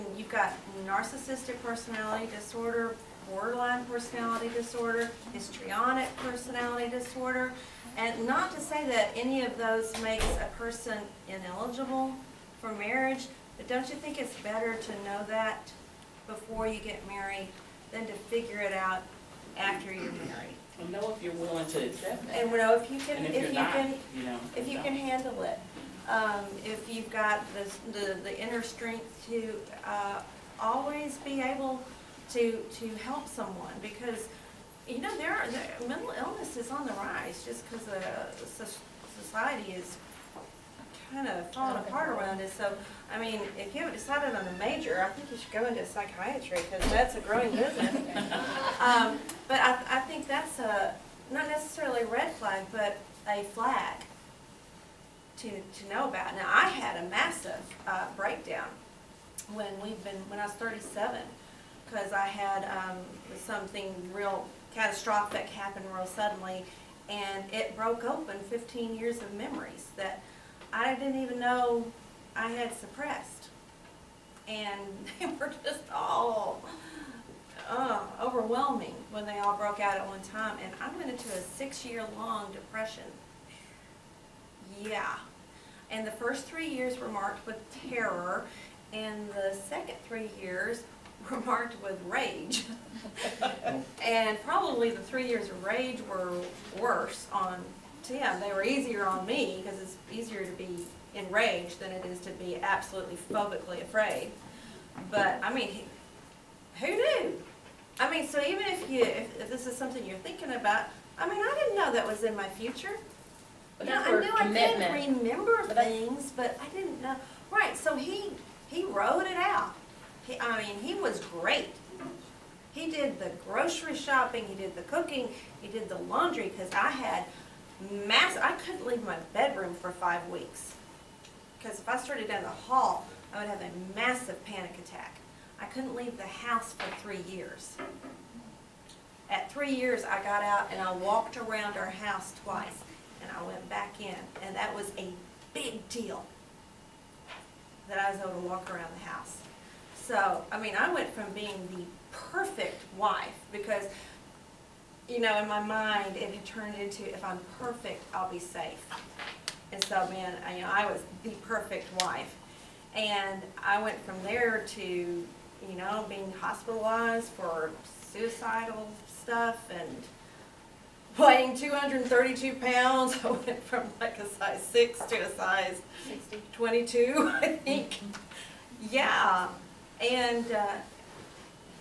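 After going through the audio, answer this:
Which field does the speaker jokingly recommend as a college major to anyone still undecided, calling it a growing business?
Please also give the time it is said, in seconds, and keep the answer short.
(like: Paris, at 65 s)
Psychiatry, at 45 s.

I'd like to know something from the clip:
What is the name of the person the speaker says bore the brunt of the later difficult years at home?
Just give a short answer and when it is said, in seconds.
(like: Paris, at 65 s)
Tim, at 98 s.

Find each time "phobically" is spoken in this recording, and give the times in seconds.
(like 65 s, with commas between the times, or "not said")
103 s.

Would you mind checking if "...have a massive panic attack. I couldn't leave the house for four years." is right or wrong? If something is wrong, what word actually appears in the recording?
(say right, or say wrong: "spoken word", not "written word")
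wrong: "three", not "four".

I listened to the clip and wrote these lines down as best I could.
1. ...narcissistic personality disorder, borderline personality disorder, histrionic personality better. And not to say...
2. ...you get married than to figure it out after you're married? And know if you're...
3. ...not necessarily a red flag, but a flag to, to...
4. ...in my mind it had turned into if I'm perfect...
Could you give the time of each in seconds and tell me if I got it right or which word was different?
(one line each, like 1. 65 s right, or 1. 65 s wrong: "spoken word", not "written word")
1. 0 s wrong: "disorder", not "better"
2. 16 s right
3. 51 s right
4. 155 s right.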